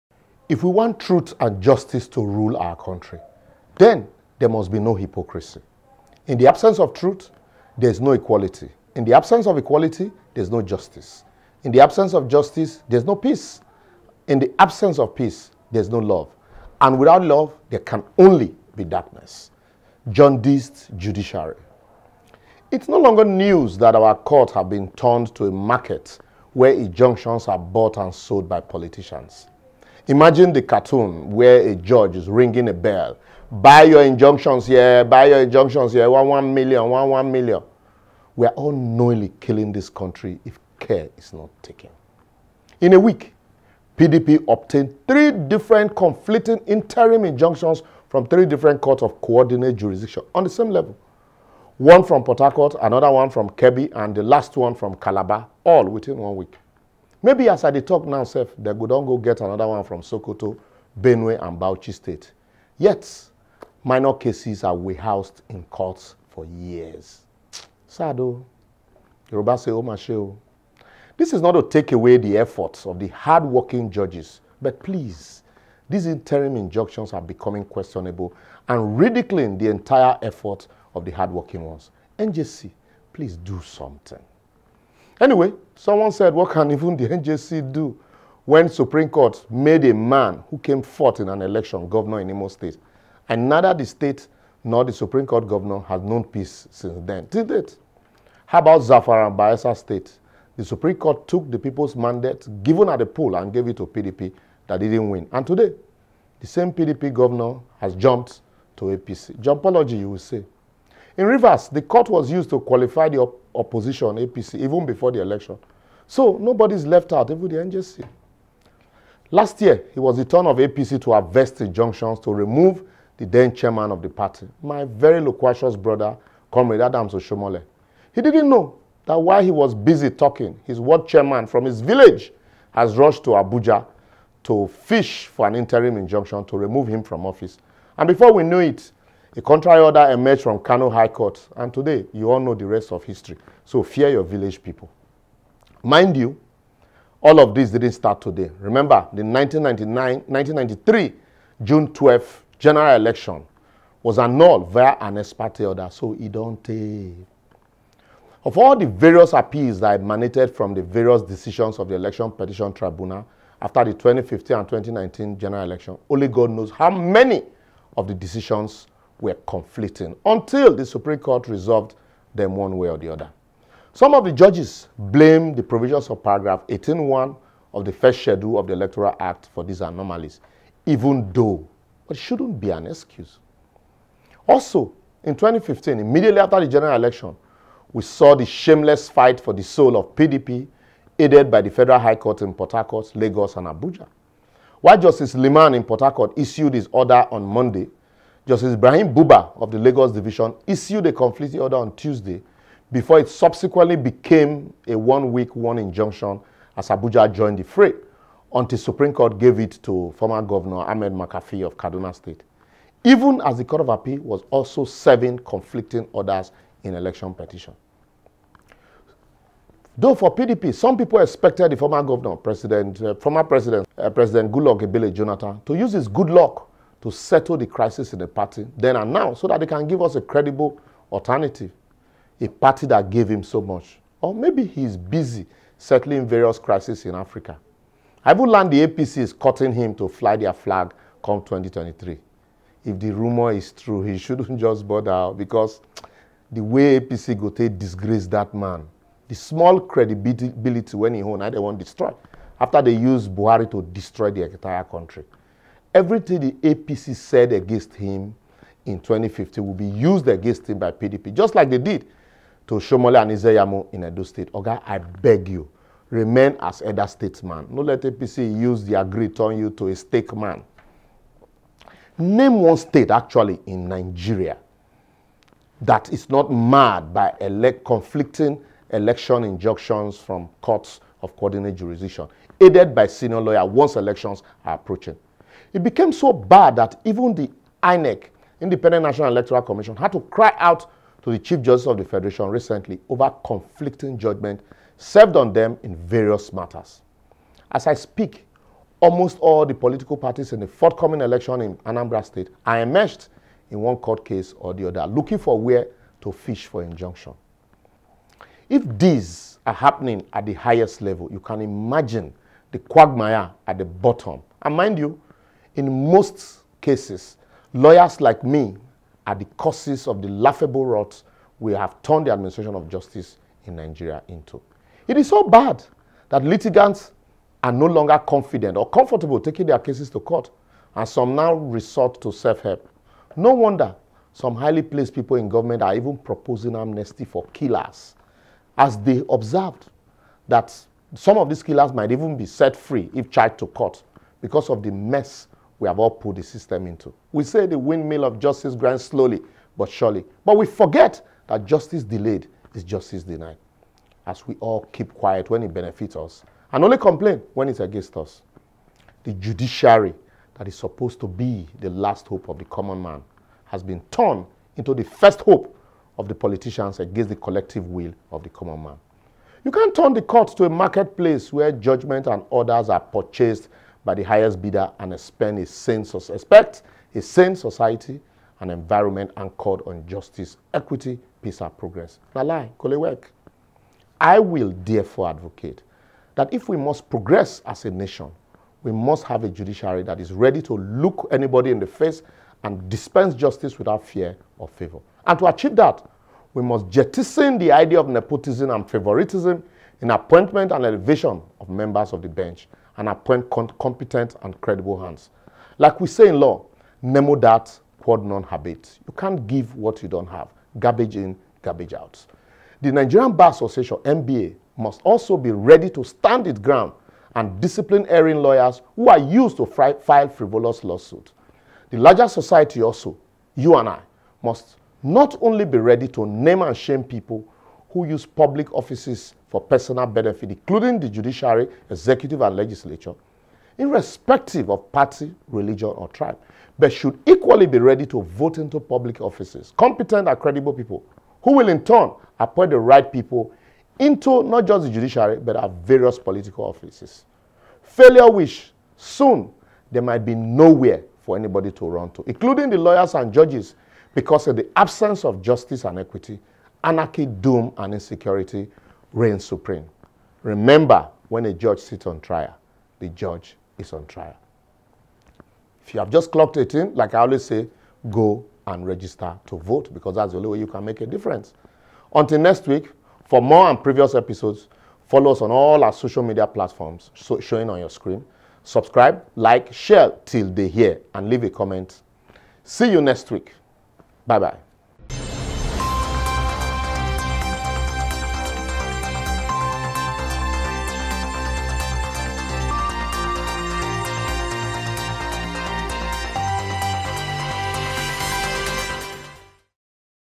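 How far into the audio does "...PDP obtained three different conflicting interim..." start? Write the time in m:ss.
0:43.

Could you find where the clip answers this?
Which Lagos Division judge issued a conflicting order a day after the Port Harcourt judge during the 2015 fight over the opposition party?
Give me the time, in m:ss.
3:18.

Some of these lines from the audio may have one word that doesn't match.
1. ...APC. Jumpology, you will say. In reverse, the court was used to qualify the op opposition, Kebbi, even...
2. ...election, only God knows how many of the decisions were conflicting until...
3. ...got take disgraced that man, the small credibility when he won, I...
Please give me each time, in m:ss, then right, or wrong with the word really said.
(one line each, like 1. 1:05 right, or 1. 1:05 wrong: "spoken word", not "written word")
1. 1:48 wrong: "APC", not "Kebbi"
2. 2:45 right
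3. 4:07 right.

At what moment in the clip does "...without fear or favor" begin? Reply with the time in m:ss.
6:33.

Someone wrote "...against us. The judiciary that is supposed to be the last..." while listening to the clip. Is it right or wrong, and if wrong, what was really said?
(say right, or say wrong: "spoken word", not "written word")
right.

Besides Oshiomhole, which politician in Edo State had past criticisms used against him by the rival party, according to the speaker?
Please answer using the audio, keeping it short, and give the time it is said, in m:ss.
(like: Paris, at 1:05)
Ize-Iyamu, at 4:23.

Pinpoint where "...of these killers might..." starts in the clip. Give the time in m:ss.
5:41.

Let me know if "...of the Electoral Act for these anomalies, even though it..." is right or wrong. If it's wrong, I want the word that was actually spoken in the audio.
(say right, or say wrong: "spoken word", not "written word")
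right.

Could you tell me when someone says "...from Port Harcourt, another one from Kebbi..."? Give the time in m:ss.
0:52.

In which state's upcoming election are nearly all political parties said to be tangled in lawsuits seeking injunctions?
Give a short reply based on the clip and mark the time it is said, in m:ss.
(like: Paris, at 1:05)
Anambra State, at 5:01.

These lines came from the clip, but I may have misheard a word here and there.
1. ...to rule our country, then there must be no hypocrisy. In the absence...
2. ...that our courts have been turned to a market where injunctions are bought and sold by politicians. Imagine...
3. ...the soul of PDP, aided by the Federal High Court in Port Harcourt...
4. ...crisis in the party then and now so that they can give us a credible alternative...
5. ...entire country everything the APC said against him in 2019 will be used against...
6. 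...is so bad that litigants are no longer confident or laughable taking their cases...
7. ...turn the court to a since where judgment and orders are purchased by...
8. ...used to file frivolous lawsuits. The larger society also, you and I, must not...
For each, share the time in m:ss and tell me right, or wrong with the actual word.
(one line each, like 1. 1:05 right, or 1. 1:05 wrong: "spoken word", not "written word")
1. 0:02 right
2. 0:23 right
3. 3:09 right
4. 3:47 right
5. 4:14 wrong: "2015", not "2019"
6. 5:25 wrong: "comfortable", not "laughable"
7. 6:09 wrong: "marketplace", not "since"
8. 6:59 right.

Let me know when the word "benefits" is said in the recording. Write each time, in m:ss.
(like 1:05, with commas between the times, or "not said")
5:55, 7:10.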